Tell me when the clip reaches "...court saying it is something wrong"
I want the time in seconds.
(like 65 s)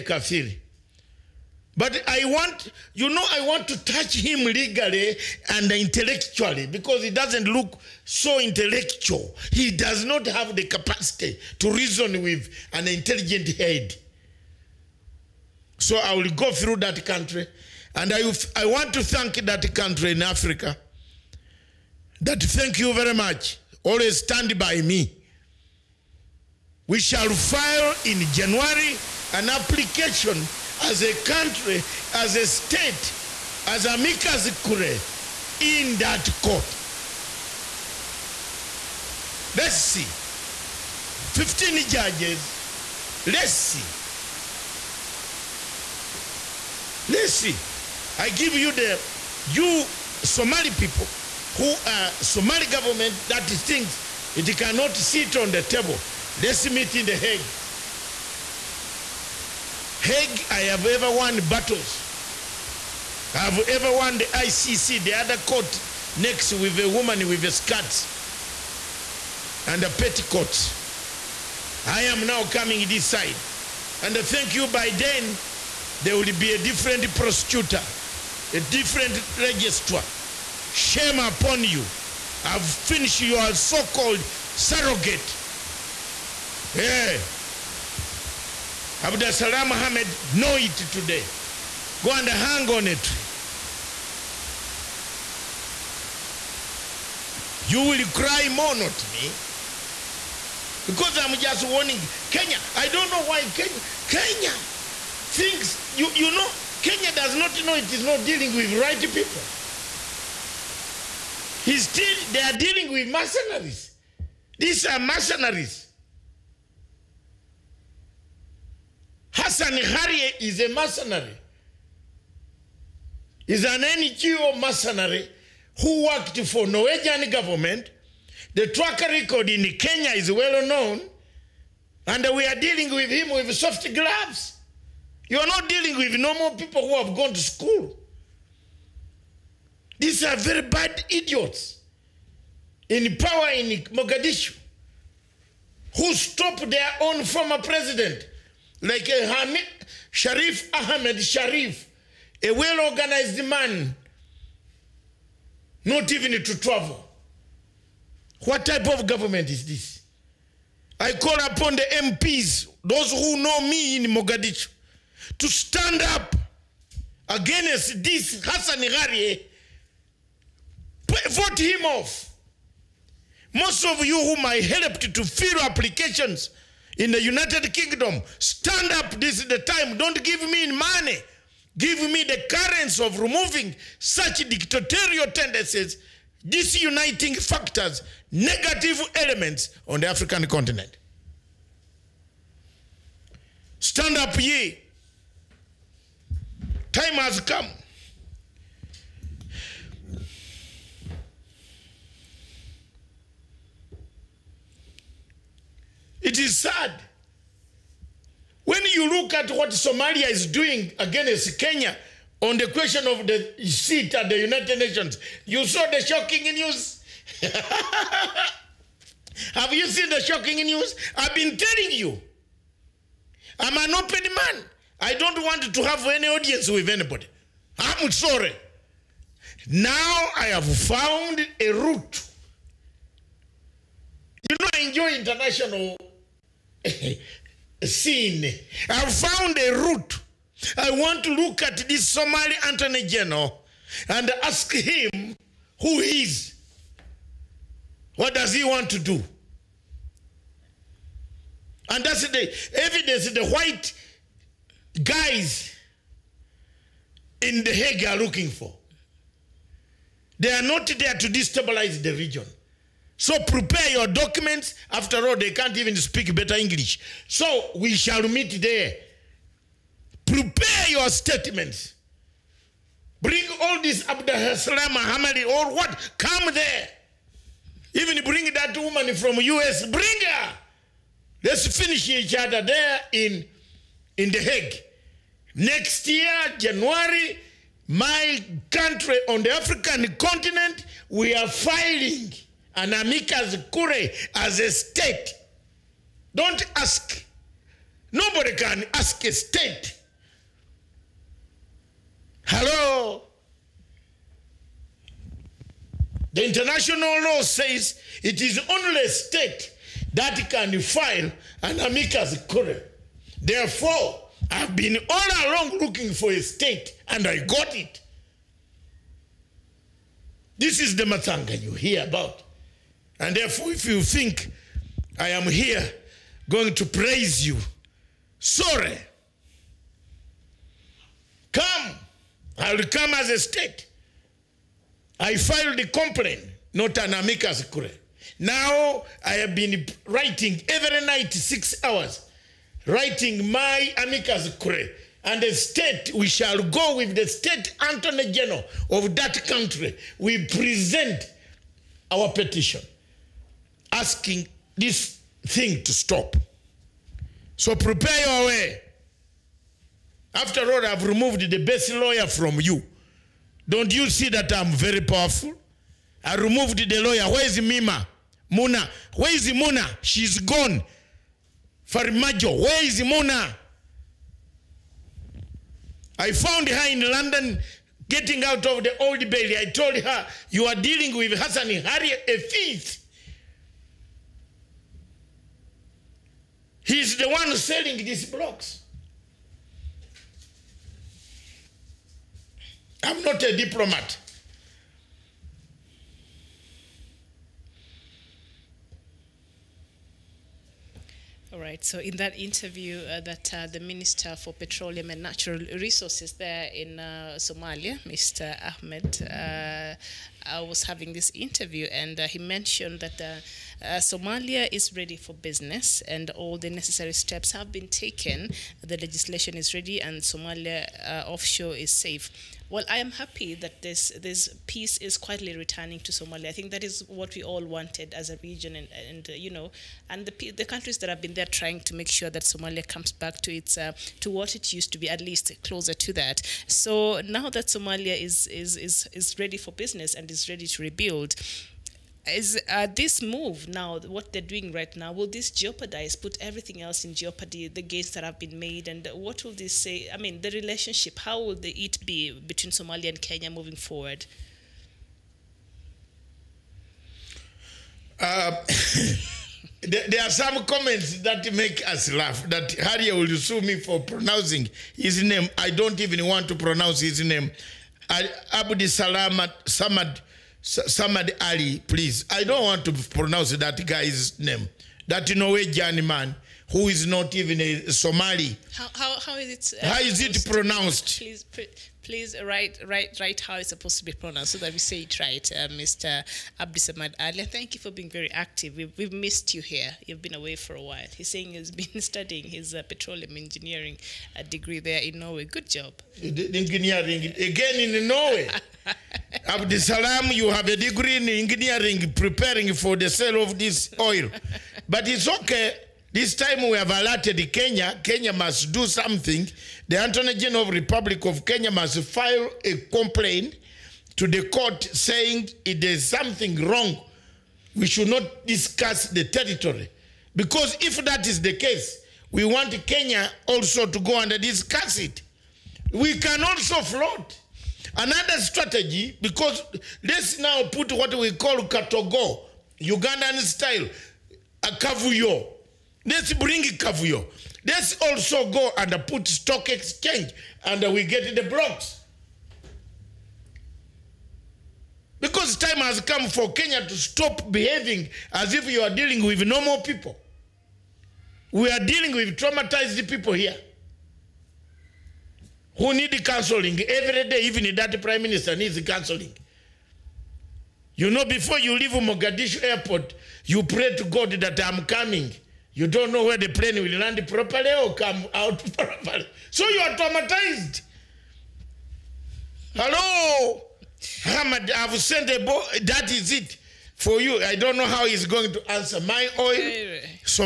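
514 s.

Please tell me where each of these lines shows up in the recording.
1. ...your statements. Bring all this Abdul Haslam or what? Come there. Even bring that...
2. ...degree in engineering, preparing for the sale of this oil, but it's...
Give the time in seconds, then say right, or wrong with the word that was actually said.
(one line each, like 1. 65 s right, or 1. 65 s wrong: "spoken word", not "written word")
1. 270 s right
2. 500 s right.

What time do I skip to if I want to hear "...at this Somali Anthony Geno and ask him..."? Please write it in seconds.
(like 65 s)
241 s.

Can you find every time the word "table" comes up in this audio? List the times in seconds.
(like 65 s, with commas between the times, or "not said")
55 s.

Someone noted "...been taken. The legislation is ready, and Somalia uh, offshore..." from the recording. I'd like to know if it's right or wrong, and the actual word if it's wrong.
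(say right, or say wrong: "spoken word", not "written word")
right.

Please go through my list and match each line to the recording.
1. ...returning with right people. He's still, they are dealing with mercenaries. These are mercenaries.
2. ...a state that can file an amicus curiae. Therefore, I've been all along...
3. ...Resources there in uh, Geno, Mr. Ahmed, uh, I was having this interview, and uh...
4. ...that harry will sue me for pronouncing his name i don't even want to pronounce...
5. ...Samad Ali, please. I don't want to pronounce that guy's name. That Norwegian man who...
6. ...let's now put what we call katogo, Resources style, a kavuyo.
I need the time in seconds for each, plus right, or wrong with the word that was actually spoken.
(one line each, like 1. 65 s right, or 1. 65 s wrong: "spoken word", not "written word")
1. 108 s wrong: "dealing", not "returning"
2. 309 s right
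3. 405 s wrong: "Somalia", not "Geno"
4. 462 s right
5. 470 s right
6. 530 s wrong: "Ugandan", not "Resources".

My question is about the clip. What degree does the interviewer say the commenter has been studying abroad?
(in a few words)
petroleum engineering.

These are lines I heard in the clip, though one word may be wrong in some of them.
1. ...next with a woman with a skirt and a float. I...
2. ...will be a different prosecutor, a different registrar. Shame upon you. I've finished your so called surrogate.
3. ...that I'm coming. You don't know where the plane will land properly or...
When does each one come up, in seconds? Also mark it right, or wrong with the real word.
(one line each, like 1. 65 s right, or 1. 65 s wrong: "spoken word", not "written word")
1. 66 s wrong: "petticoat", not "float"
2. 76 s right
3. 564 s right.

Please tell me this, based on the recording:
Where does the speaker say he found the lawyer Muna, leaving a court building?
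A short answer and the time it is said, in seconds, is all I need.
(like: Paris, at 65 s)
London, at 377 s.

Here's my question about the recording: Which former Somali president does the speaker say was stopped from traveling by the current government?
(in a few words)
Sharif Ahmed Sharif.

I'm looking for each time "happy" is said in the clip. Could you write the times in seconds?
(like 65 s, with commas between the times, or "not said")
423 s.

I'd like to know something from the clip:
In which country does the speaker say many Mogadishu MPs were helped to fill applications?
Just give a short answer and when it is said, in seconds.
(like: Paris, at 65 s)
United Kingdom, at 177 s.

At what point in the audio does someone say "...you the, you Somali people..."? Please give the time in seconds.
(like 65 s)
48 s.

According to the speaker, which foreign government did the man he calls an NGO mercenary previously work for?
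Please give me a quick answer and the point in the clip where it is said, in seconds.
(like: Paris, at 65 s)
Norwegian government, at 126 s.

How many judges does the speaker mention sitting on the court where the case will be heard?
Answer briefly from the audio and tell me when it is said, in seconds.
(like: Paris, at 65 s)
15, at 41 s.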